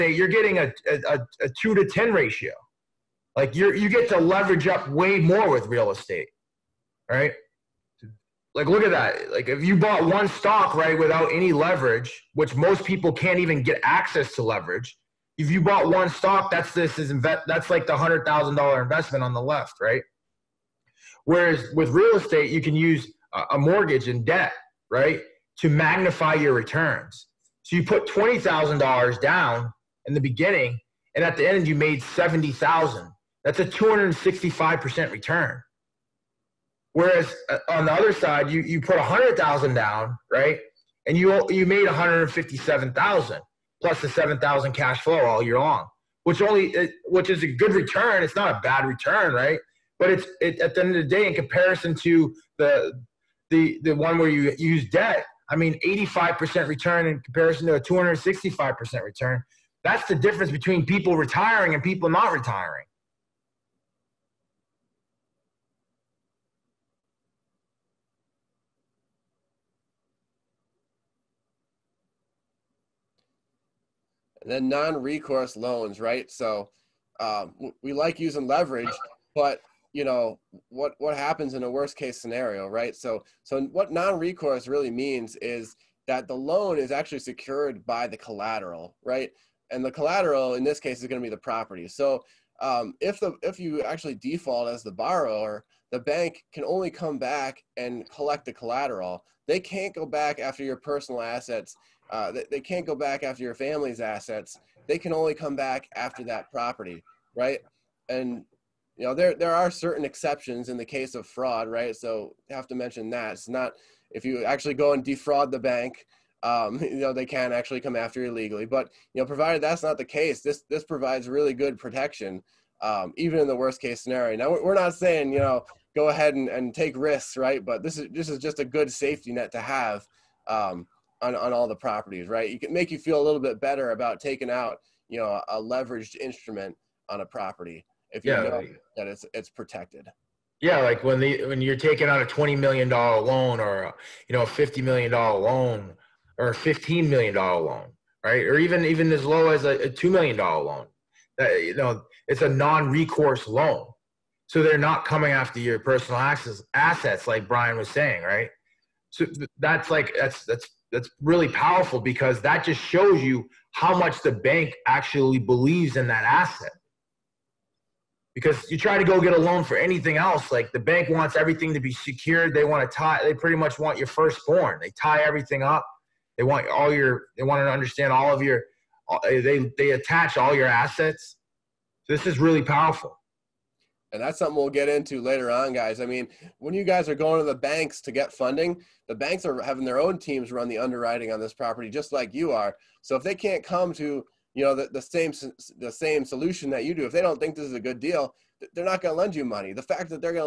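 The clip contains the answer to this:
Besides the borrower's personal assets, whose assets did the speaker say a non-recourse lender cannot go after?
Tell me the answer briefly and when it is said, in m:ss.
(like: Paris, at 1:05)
family's assets, at 1:43.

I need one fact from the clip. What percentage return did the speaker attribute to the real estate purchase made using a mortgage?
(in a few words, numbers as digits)
265%.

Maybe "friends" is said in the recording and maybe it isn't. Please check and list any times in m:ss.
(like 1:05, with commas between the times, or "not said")
not said.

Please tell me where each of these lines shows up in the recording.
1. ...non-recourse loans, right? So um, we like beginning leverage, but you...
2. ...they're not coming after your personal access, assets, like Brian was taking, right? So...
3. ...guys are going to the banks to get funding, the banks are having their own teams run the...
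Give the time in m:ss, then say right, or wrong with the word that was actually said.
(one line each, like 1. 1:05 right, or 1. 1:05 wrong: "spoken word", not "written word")
1. 1:14 wrong: "using", not "beginning"
2. 2:34 wrong: "saying", not "taking"
3. 3:06 right.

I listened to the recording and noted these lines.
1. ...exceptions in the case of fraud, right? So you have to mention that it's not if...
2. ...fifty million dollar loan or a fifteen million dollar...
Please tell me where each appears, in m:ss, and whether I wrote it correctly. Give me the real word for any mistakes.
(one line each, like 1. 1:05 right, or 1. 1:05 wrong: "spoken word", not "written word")
1. 1:50 right
2. 2:24 right.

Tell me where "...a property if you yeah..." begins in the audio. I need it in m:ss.
2:17.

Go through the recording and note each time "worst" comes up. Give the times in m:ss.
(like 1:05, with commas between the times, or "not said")
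1:21, 2:03.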